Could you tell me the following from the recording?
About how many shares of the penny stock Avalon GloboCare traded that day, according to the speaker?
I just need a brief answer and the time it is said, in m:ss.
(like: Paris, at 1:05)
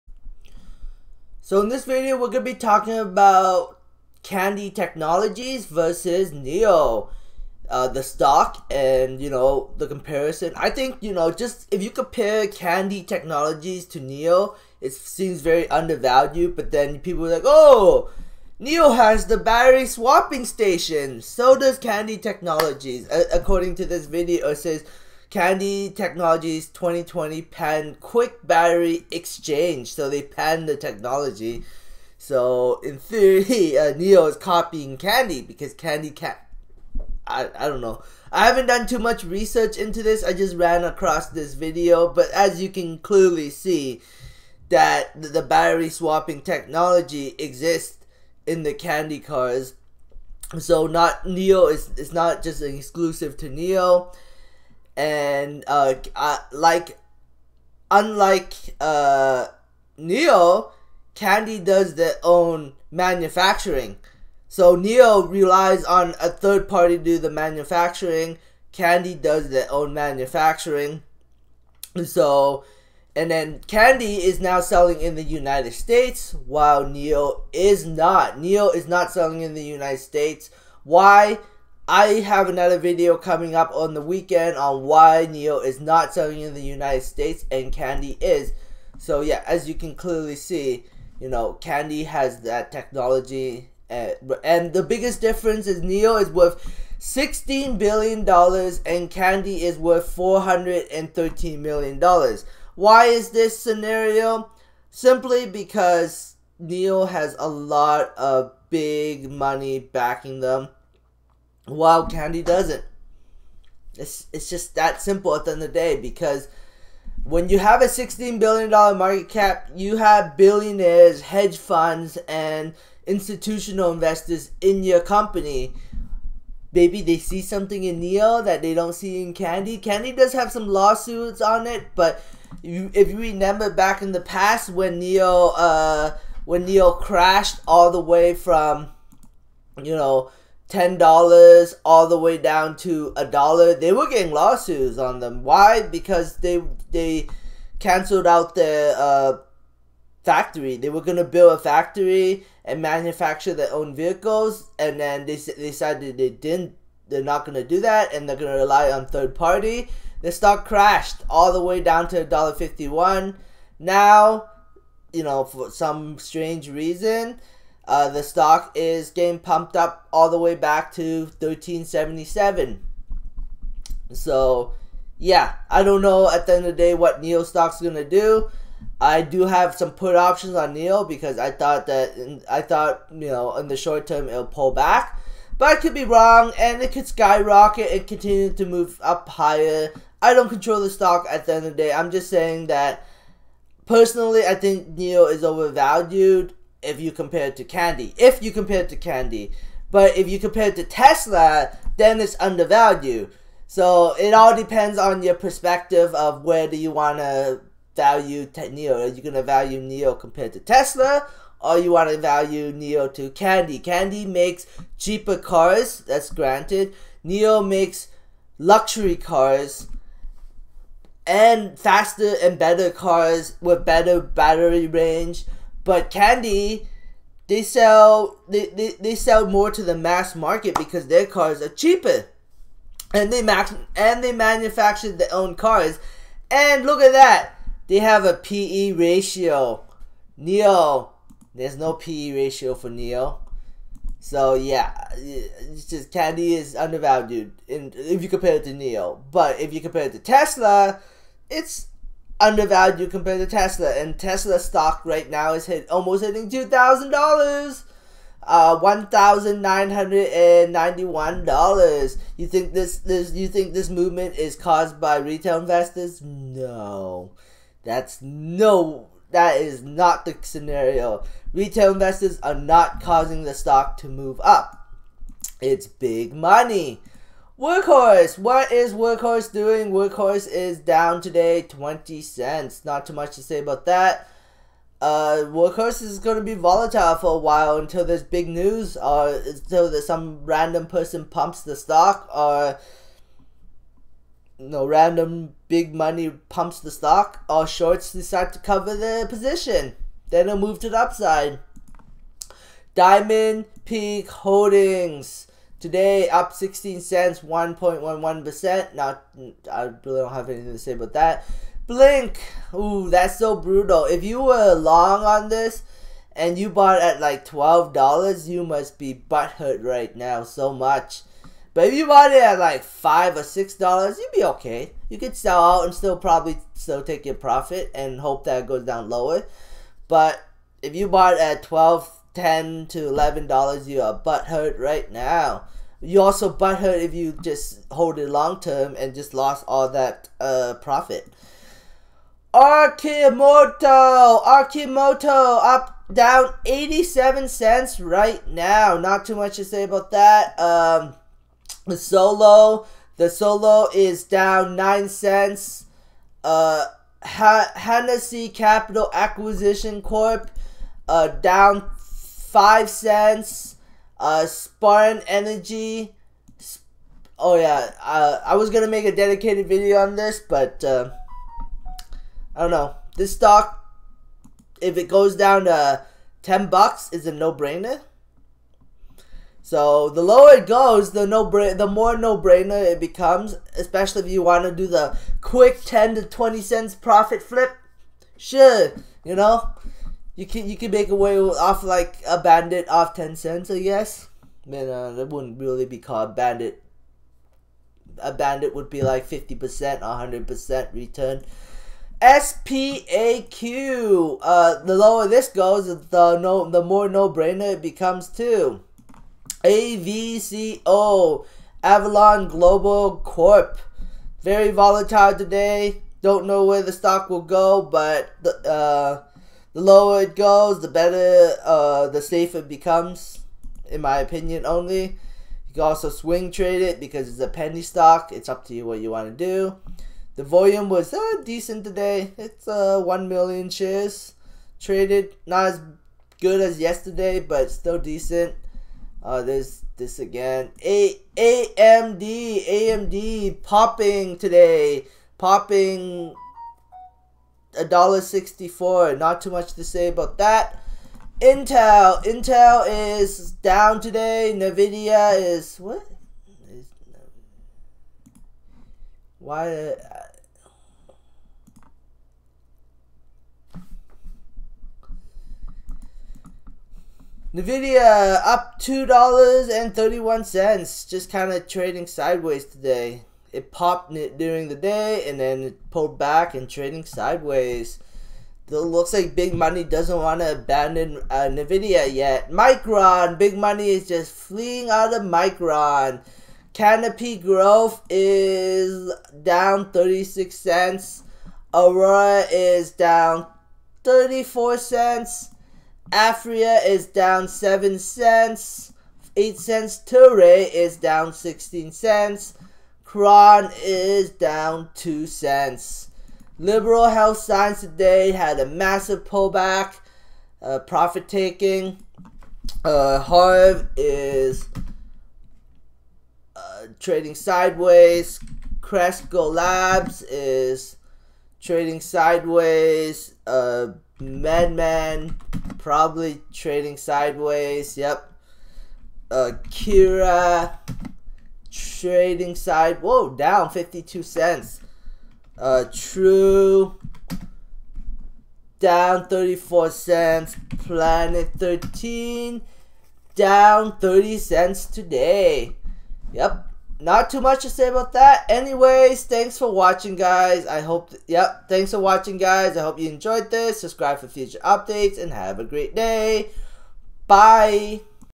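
1 million, at 7:13.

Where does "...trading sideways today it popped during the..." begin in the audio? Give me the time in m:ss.
7:51.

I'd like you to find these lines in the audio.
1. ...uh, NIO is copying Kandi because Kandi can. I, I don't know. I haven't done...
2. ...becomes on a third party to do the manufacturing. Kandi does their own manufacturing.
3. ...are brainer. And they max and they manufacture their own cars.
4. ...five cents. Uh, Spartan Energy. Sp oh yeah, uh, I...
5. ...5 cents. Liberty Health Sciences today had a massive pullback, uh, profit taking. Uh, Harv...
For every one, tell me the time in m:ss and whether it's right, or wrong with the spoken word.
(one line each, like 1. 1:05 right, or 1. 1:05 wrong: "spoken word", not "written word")
1. 0:33 right
2. 1:05 wrong: "relies", not "becomes"
3. 3:51 wrong: "cheaper", not "brainer"
4. 6:02 right
5. 8:24 wrong: "2", not "5".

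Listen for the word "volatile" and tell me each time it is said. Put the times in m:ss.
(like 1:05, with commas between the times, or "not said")
4:46, 6:54.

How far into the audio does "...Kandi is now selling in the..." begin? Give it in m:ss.
1:13.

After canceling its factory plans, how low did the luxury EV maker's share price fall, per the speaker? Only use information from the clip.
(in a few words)
$1.51.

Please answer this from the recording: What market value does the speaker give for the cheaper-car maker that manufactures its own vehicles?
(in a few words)
$413 million.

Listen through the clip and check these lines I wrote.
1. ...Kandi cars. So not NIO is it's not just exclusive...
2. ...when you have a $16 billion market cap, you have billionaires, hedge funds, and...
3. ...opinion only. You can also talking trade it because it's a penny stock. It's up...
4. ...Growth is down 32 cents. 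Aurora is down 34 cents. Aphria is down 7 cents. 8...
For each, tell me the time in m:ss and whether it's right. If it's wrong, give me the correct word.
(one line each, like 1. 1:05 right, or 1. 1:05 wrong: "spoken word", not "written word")
1. 0:48 right
2. 1:57 right
3. 7:04 wrong: "swing", not "talking"
4. 8:07 wrong: "36", not "32".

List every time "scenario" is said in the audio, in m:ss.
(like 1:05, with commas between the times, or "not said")
1:43, 4:30.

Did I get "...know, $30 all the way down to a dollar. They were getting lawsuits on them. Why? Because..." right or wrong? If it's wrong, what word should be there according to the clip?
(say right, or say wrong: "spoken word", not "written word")
wrong: "10", not "30".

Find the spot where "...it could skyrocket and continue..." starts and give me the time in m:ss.
3:06.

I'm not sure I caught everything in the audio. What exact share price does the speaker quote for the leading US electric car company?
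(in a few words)
$1,991.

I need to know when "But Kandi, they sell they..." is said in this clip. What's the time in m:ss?
3:45.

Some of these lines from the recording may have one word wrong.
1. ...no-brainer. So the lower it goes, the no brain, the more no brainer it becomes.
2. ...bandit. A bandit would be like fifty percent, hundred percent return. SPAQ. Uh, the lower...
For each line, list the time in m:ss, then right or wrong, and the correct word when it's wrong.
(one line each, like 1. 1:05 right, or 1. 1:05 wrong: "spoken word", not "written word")
1. 6:17 right
2. 6:36 right.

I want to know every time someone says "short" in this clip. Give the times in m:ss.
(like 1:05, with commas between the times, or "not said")
3:03, 4:57.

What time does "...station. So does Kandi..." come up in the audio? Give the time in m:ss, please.
0:20.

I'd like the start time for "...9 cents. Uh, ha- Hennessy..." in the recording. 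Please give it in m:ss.
5:54.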